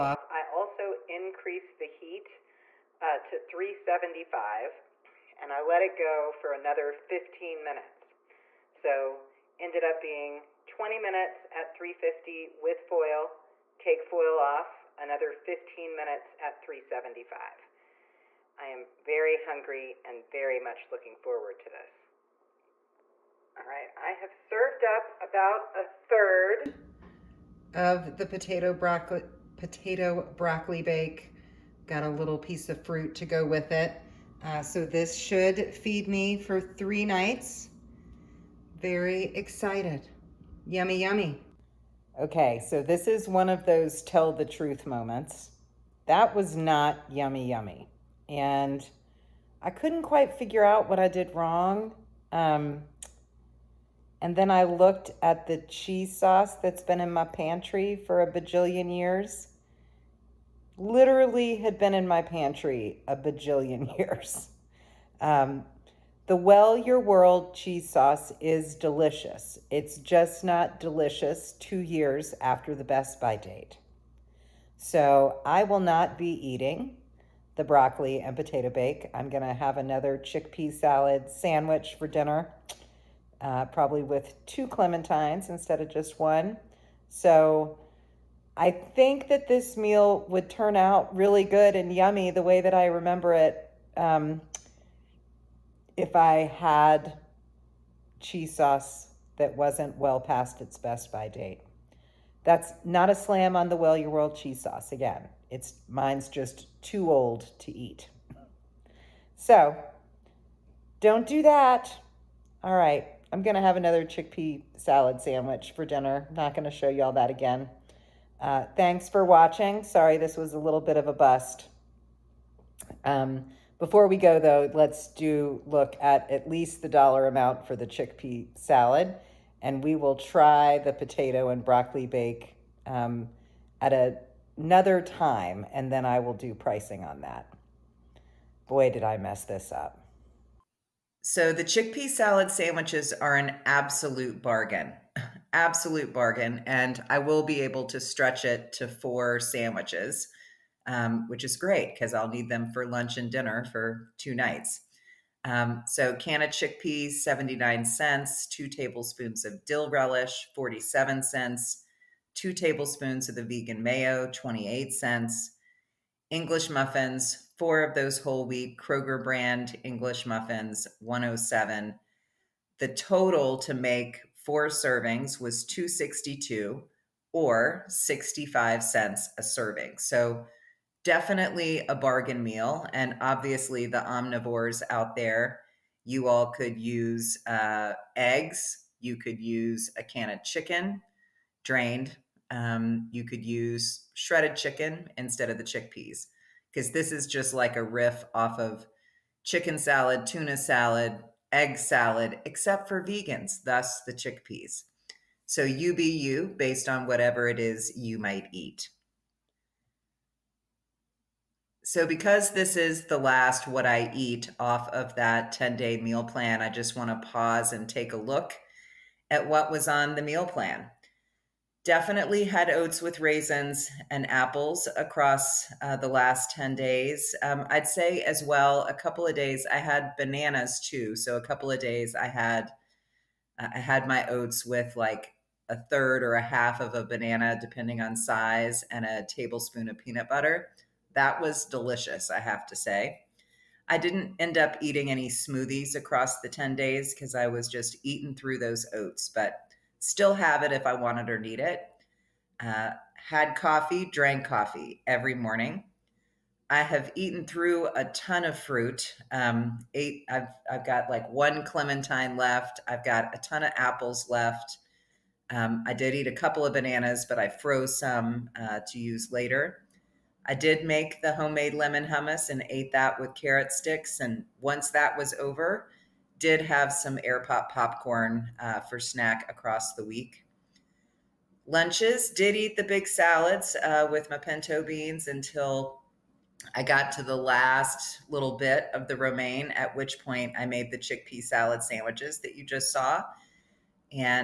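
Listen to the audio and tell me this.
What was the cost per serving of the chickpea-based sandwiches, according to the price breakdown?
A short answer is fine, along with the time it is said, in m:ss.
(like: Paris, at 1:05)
65 cents, at 2:57.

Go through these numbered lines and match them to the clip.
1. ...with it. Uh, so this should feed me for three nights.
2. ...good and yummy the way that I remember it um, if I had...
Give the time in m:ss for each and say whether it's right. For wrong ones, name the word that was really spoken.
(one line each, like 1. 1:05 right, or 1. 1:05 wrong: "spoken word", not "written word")
1. 0:33 right
2. 1:31 right.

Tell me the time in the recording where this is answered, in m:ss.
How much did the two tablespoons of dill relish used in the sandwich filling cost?
2:40.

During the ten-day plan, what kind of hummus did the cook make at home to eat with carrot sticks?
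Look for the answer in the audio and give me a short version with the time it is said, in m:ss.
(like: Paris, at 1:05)
lemon hummus, at 4:31.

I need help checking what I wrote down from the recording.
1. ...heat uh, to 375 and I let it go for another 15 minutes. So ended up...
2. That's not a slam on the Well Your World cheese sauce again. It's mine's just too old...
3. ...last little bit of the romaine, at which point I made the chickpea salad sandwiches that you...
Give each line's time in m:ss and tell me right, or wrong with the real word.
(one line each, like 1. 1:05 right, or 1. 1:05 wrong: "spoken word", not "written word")
1. 0:01 right
2. 1:42 right
3. 4:47 right.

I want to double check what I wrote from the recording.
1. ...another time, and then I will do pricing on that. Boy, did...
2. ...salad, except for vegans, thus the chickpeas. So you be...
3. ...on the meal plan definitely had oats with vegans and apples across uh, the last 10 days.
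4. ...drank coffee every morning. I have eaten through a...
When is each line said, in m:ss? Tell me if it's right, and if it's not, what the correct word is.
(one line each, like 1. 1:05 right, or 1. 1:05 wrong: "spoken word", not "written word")
1. 2:14 right
2. 3:21 right
3. 3:39 wrong: "raisins", not "vegans"
4. 4:14 right.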